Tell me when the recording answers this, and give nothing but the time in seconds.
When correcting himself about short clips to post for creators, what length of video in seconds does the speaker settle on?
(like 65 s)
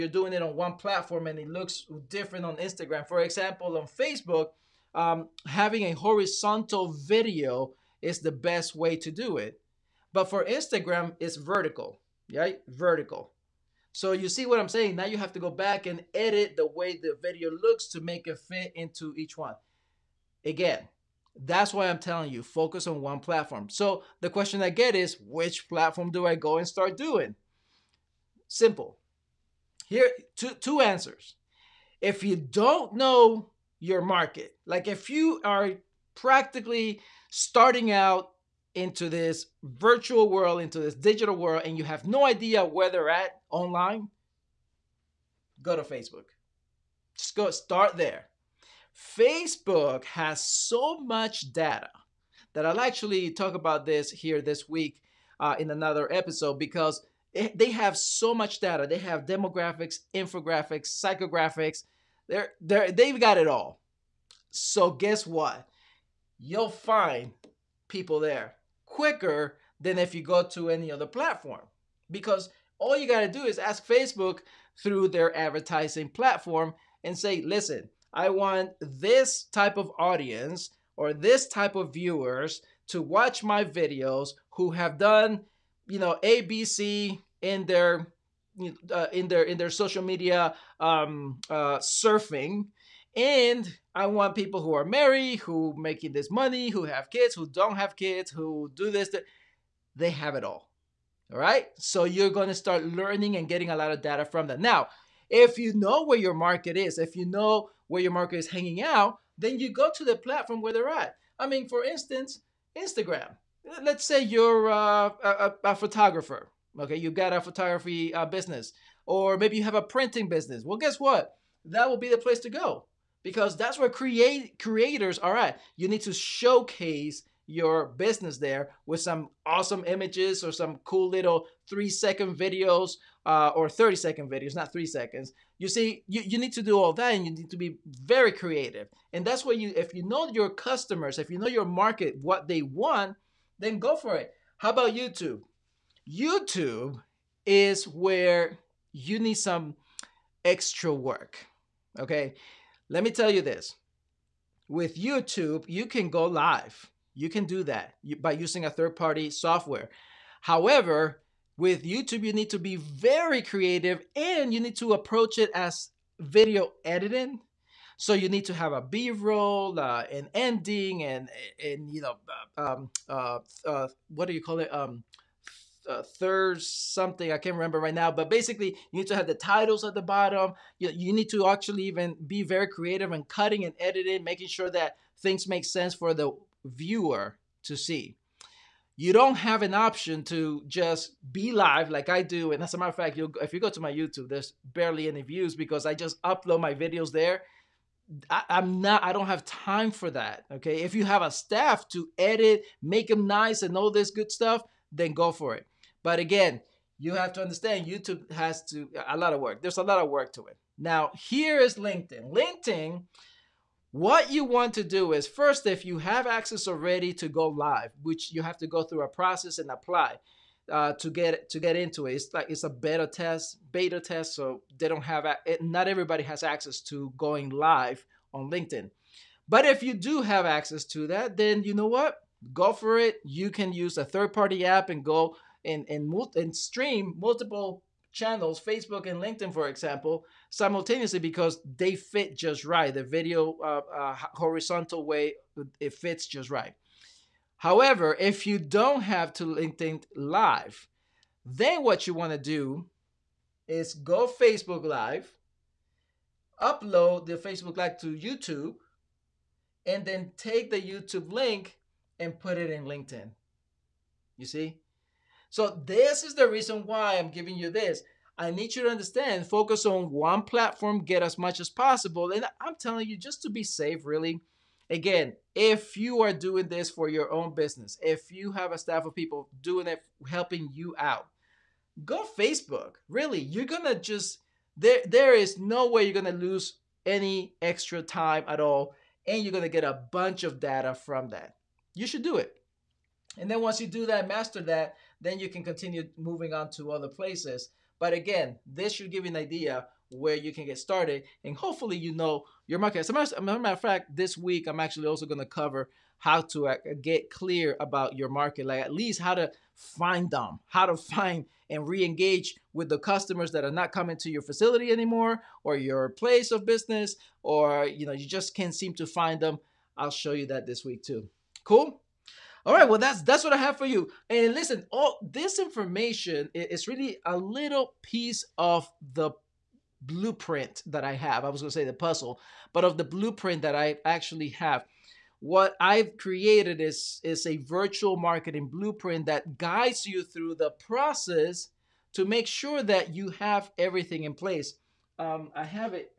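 133 s.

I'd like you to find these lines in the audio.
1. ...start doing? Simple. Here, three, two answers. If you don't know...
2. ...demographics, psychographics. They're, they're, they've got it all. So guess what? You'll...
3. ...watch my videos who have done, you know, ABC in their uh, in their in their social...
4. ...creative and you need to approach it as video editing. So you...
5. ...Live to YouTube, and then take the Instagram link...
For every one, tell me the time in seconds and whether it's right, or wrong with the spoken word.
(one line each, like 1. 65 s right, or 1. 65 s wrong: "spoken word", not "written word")
1. 26 s wrong: "two", not "three"
2. 60 s wrong: "infographics", not "demographics"
3. 83 s right
4. 163 s right
5. 257 s wrong: "YouTube", not "Instagram".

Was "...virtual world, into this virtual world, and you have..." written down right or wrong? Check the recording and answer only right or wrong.
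wrong.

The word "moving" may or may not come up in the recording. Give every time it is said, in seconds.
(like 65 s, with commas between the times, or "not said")
296 s.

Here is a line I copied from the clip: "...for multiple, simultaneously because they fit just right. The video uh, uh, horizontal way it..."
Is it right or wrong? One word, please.
wrong.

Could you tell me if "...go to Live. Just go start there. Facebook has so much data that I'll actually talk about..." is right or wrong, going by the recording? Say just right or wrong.
wrong.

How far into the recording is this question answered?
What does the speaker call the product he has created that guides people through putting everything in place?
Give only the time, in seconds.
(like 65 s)
337 s.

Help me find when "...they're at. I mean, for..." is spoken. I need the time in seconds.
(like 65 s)
110 s.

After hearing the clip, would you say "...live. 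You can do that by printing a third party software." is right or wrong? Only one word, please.
wrong.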